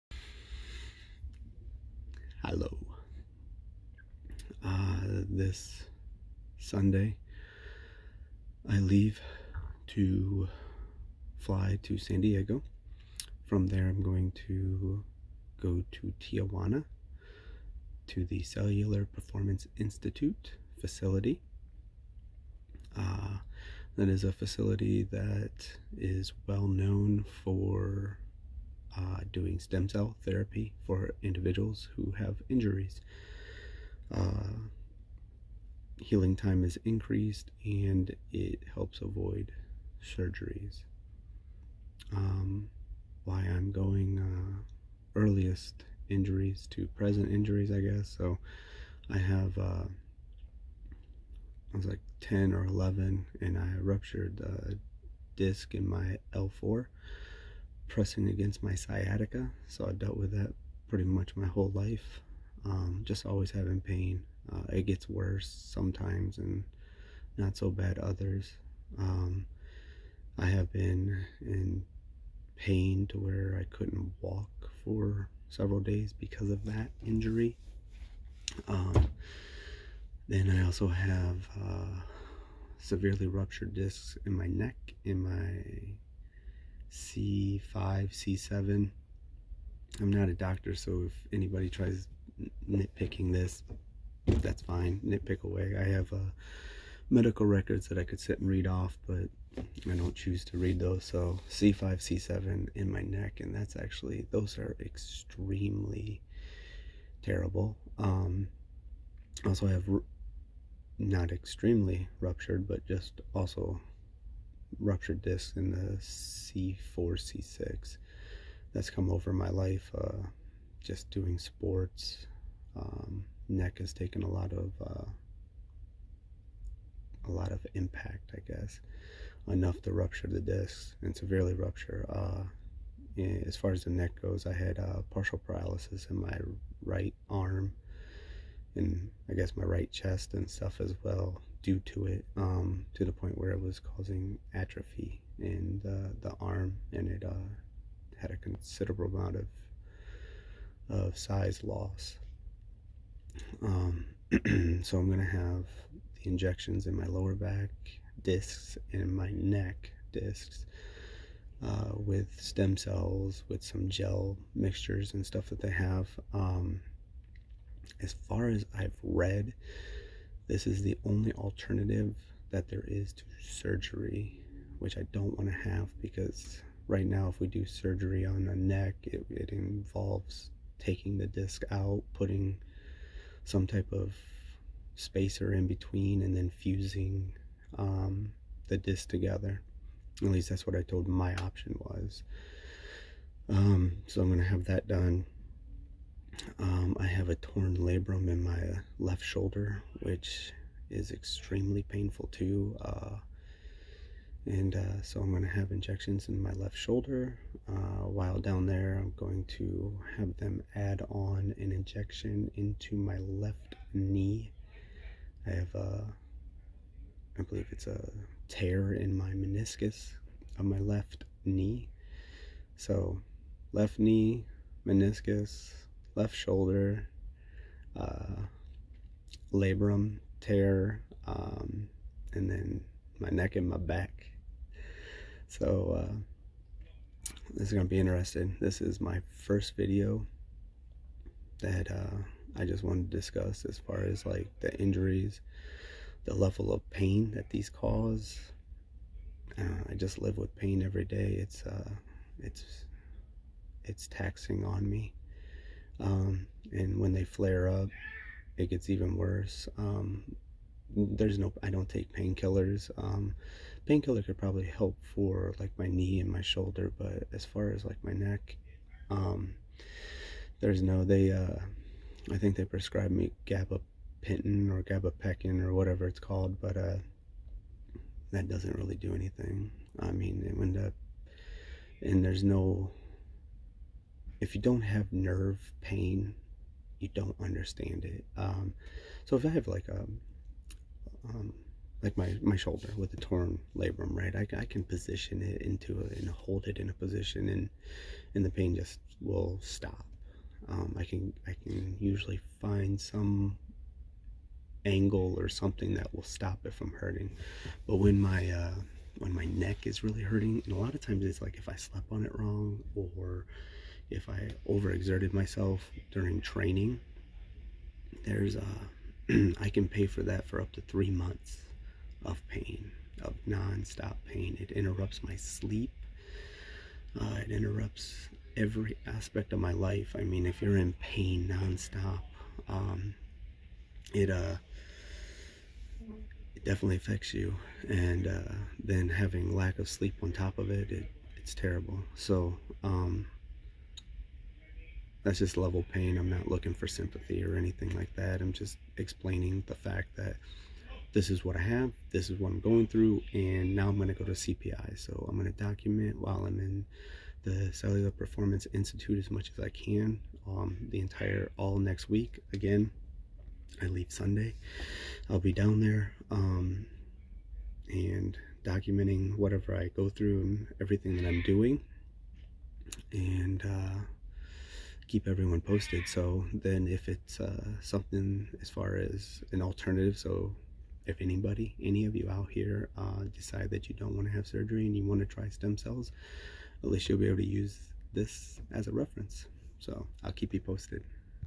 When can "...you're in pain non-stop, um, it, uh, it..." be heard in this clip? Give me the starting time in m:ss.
5:30.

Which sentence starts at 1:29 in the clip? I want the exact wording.
I'm not a doctor, so if anybody tries nitpicking this, that's fine.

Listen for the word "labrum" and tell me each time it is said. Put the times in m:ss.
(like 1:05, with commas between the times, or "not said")
3:17, 3:49, 4:53.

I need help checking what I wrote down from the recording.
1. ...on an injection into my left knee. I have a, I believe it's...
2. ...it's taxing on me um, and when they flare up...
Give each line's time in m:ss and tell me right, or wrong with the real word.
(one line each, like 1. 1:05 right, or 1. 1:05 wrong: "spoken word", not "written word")
1. 3:31 right
2. 4:13 right.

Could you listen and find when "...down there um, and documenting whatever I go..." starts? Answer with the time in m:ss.
6:05.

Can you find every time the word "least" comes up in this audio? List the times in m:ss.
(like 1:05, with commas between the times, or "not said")
3:10, 6:26.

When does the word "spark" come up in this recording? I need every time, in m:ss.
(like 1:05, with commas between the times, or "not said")
not said.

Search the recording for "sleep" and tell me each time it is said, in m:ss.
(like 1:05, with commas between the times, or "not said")
5:25, 5:39.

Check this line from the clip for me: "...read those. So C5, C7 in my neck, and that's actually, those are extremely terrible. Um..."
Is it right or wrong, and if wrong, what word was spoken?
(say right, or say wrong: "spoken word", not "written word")
right.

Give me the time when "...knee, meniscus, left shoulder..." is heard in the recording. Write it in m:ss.
3:43.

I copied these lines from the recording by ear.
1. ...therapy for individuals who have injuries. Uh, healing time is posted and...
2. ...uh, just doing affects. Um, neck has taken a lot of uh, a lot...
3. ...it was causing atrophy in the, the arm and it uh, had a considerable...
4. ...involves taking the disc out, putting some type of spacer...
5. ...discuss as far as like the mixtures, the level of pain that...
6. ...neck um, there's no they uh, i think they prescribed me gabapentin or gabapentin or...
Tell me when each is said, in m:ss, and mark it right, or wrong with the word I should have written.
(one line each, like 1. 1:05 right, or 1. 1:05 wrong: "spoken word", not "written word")
1. 0:30 wrong: "increased", not "posted"
2. 1:59 wrong: "sports", not "affects"
3. 2:23 right
4. 2:59 right
5. 4:03 wrong: "injuries", not "mixtures"
6. 4:28 right.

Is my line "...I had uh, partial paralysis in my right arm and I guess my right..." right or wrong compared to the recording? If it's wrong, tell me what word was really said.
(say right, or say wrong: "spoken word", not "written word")
right.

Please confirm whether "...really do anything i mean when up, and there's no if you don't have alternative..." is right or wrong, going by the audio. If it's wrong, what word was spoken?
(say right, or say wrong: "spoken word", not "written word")
wrong: "nerve", not "alternative".